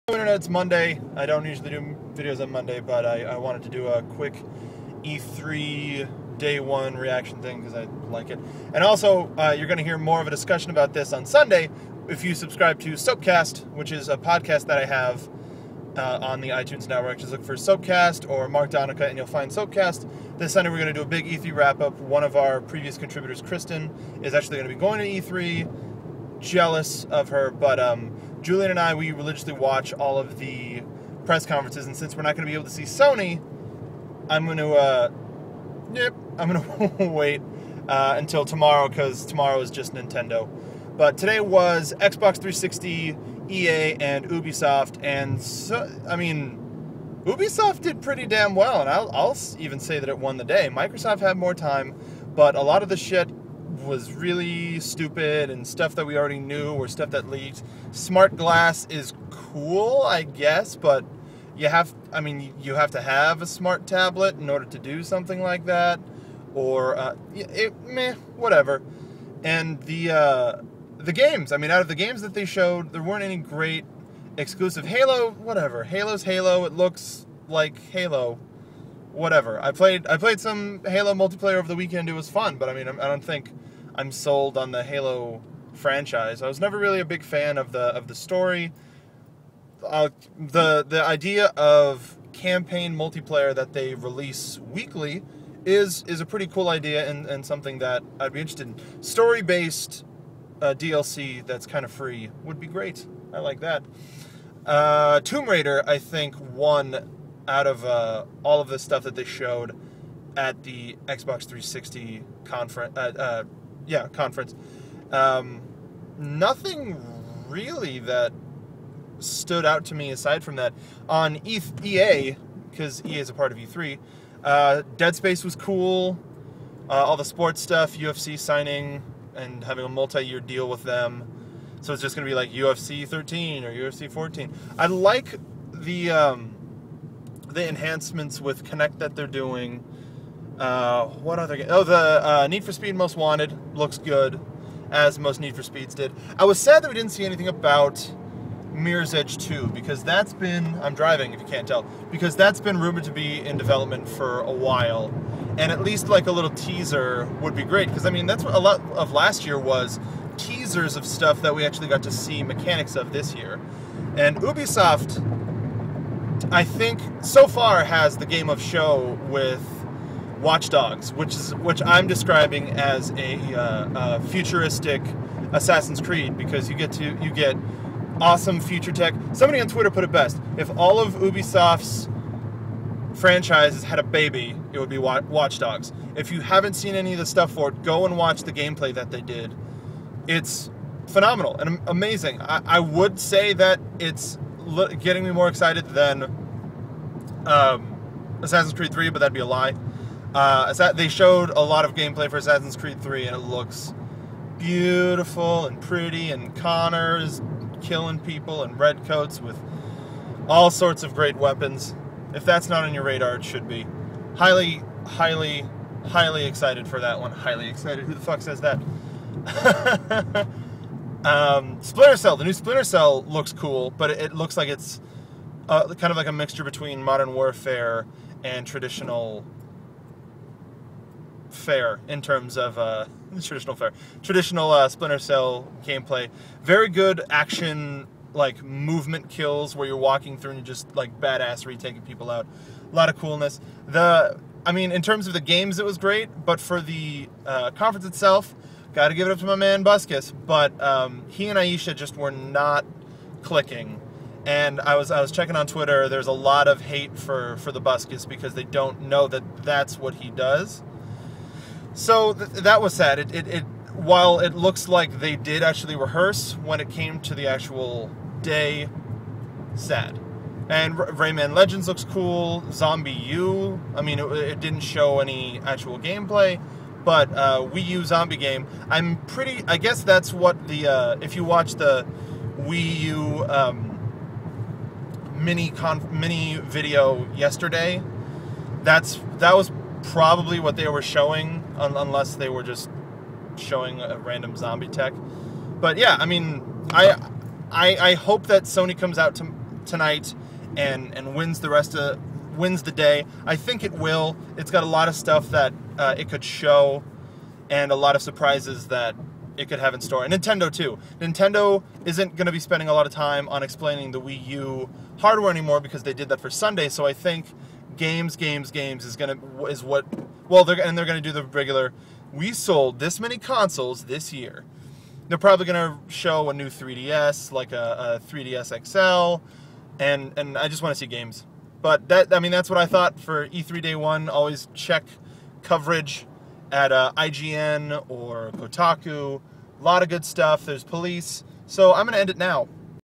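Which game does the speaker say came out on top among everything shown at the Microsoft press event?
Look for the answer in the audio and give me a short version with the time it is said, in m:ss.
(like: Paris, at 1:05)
Tomb Raider, at 1:45.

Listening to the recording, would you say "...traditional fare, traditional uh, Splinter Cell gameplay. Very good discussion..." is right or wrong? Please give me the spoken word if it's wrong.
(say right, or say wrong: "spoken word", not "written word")
wrong: "action", not "discussion".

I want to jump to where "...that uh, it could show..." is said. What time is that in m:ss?
5:05.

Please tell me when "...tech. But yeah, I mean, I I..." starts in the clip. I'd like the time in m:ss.
4:54.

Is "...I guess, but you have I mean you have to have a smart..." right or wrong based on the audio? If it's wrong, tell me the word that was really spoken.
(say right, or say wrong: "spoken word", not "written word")
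right.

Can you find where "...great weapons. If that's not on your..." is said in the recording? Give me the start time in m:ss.
3:31.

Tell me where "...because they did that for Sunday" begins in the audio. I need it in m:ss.
5:15.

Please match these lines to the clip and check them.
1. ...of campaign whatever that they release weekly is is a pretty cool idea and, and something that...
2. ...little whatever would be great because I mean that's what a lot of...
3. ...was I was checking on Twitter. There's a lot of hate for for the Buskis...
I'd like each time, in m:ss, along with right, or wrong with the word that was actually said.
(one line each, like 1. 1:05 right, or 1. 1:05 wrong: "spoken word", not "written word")
1. 1:31 wrong: "multiplayer", not "whatever"
2. 2:36 wrong: "teaser", not "whatever"
3. 4:14 right.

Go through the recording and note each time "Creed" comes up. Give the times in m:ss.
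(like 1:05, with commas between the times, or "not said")
2:56, 3:18, 3:22.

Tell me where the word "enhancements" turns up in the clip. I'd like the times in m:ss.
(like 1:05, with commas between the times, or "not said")
2:17.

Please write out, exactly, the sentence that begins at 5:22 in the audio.
We sold this many consoles this year.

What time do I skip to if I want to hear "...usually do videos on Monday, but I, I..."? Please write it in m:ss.
0:01.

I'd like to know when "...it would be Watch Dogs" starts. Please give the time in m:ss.
3:04.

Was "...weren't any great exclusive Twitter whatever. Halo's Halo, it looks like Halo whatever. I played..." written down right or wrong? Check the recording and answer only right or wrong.
wrong.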